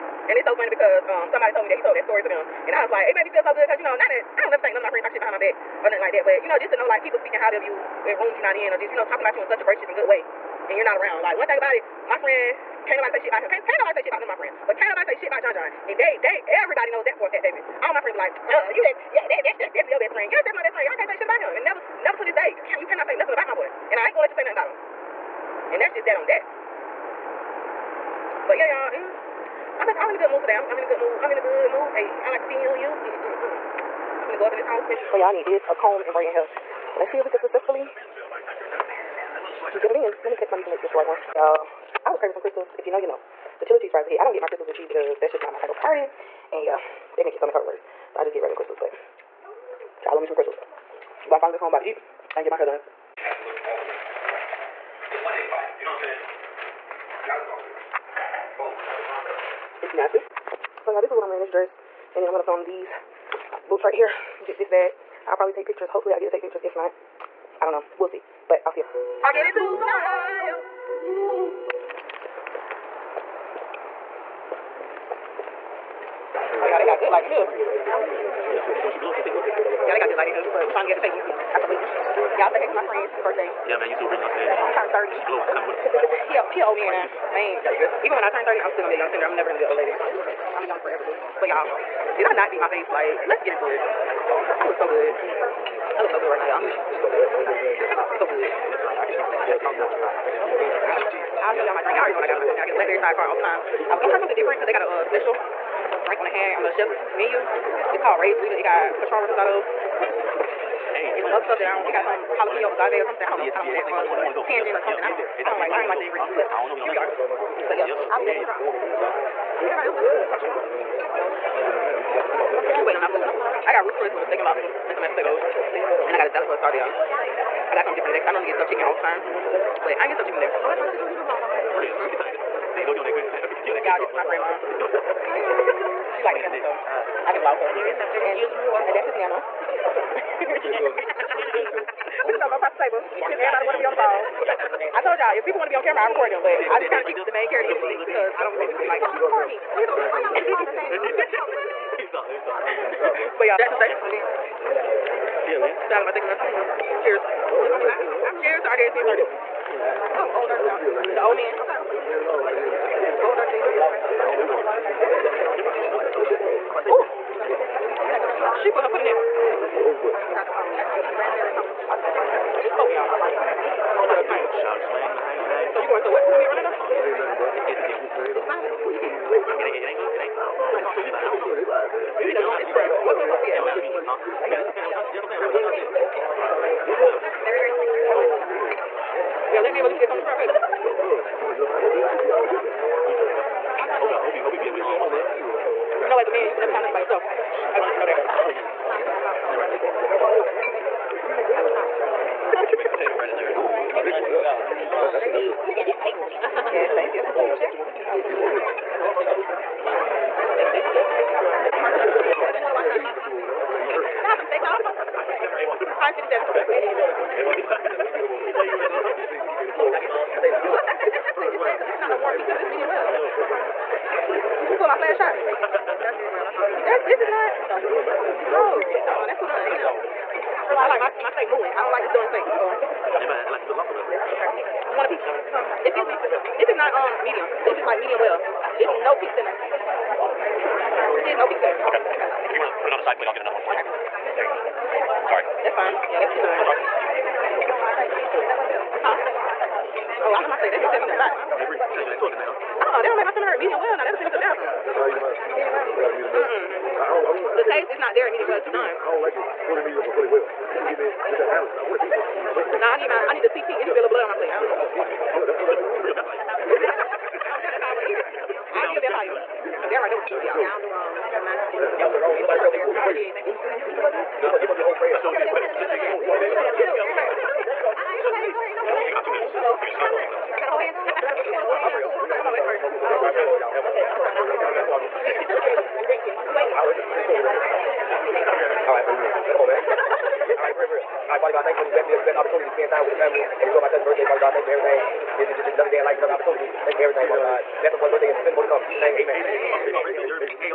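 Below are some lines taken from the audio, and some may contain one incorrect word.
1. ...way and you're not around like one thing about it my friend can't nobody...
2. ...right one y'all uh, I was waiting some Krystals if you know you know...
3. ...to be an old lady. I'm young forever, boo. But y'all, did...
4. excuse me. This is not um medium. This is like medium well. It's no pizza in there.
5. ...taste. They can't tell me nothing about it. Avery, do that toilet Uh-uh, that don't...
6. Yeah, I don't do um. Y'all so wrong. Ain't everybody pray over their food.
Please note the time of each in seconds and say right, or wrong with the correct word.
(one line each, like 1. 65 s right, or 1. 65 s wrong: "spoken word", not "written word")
1. 10 s right
2. 40 s wrong: "craving", not "waiting"
3. 89 s right
4. 235 s right
5. 250 s wrong: "state", not "taste"
6. 270 s wrong: "nobody", not "everybody".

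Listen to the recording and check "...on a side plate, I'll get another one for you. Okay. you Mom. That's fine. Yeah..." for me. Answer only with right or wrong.
wrong.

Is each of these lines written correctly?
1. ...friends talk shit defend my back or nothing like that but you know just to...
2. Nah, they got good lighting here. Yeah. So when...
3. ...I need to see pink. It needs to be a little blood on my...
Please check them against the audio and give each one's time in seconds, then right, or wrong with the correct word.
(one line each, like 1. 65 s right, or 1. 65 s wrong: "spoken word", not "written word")
1. 4 s wrong: "behind", not "defend"
2. 76 s right
3. 263 s right.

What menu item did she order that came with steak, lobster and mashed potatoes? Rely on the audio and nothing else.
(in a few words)
Ruth's Choice.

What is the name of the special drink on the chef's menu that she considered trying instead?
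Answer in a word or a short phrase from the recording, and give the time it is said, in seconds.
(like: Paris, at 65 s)
Raised Rita, at 108 s.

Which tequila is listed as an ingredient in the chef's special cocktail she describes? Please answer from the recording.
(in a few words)
Patron Reposado.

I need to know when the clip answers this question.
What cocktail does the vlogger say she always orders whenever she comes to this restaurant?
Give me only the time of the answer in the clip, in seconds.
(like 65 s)
102 s.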